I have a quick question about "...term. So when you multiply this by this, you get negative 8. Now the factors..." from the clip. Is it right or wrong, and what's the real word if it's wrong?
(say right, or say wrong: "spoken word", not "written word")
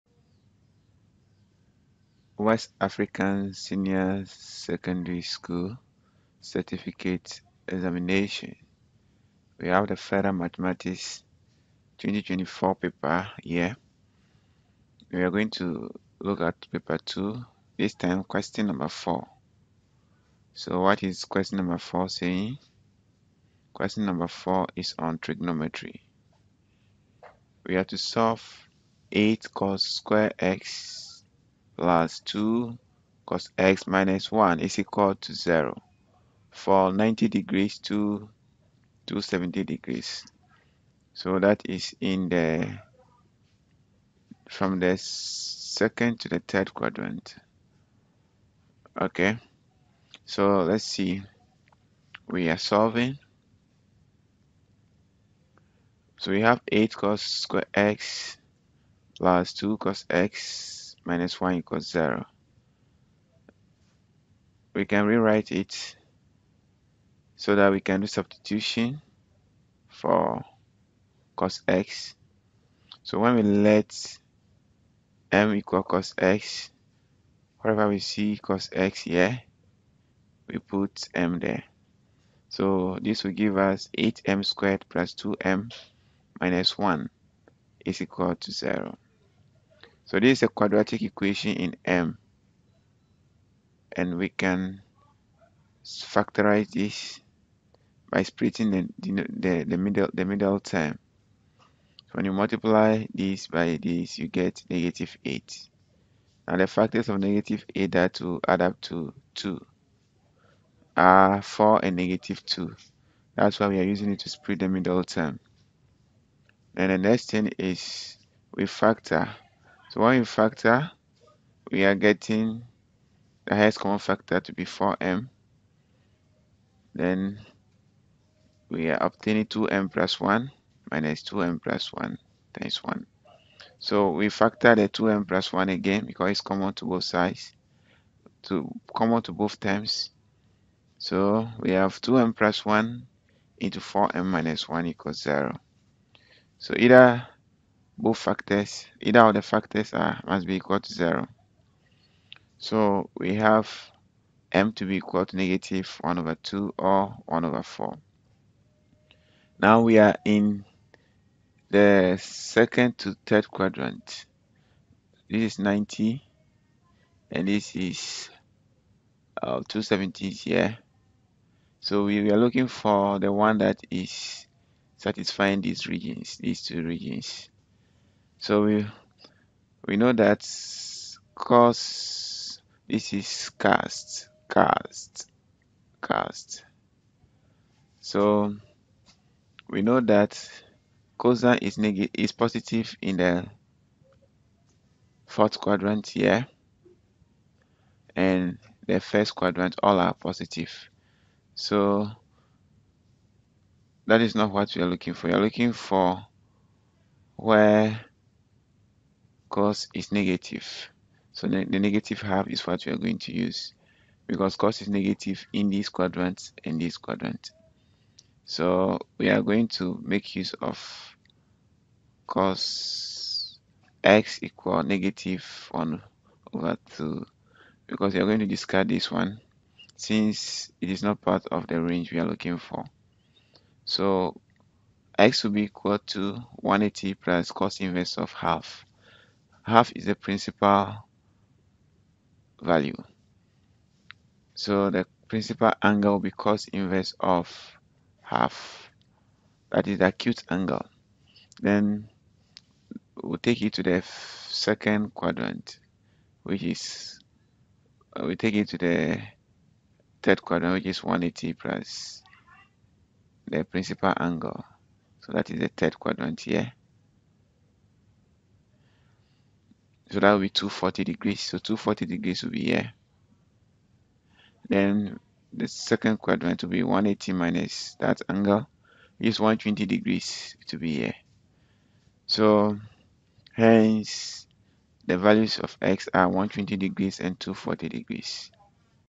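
right.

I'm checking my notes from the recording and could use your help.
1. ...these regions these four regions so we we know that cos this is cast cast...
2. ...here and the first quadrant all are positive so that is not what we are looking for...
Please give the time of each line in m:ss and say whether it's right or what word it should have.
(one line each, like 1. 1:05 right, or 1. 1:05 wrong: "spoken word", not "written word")
1. 2:55 wrong: "two", not "four"
2. 3:16 right.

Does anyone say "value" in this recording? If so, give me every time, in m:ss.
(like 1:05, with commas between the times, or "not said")
4:02, 4:45.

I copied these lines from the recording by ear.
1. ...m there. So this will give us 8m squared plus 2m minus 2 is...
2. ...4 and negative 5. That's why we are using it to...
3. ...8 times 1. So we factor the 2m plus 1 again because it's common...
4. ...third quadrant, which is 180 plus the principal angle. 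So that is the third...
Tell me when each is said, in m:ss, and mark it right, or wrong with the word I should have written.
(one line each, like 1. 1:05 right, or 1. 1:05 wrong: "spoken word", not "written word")
1. 1:21 wrong: "1", not "2"
2. 1:51 wrong: "2", not "5"
3. 2:11 wrong: "1", not "8"
4. 4:20 right.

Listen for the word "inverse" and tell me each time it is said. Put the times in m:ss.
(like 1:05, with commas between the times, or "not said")
3:57, 4:06.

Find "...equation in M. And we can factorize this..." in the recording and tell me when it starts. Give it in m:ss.
1:31.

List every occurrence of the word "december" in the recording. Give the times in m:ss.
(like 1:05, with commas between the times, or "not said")
not said.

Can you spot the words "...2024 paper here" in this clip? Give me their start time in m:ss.
0:11.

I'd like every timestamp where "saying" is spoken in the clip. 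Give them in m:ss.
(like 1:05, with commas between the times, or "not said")
0:22.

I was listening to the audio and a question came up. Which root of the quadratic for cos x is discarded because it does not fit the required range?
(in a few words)
1/4.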